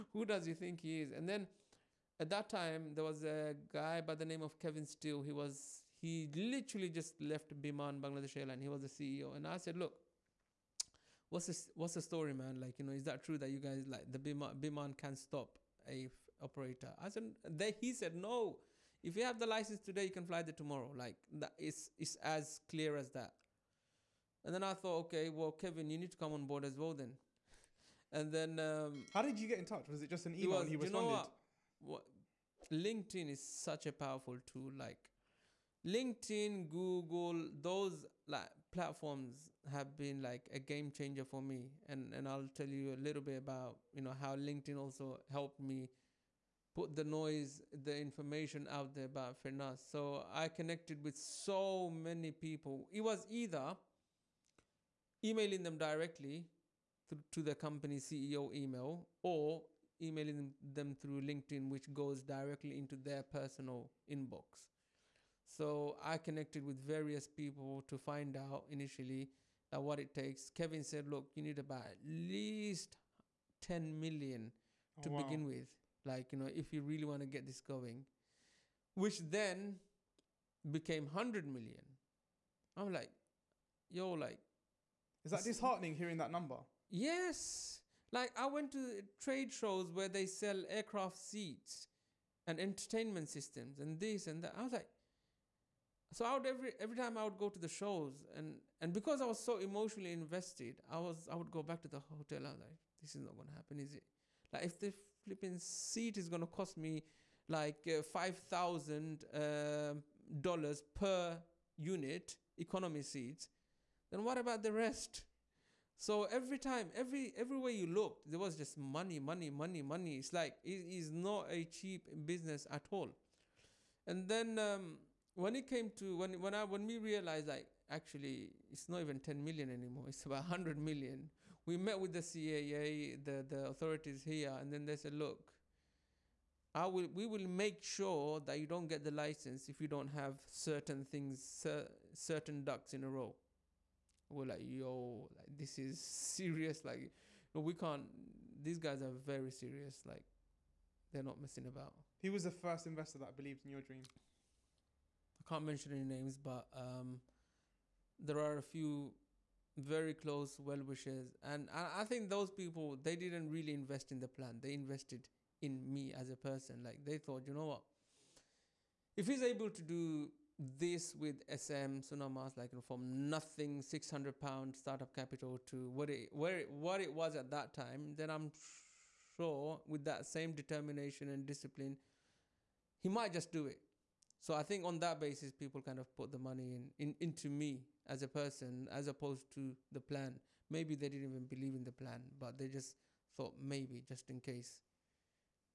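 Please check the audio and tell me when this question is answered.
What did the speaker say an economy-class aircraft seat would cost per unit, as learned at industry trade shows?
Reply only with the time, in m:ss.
1:48.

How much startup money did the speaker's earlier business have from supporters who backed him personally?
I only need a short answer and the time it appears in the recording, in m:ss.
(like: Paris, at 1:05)
£600, at 2:53.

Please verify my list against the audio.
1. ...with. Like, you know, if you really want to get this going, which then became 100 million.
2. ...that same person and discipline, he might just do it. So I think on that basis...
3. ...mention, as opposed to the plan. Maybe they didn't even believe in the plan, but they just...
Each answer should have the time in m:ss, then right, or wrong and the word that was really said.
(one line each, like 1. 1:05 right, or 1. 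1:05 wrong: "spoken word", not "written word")
1. 1:15 right
2. 3:00 wrong: "determination", not "person"
3. 3:08 wrong: "person", not "mention".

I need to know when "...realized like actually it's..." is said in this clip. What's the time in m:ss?
2:06.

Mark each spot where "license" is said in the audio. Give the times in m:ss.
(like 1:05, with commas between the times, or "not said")
0:19, 2:19.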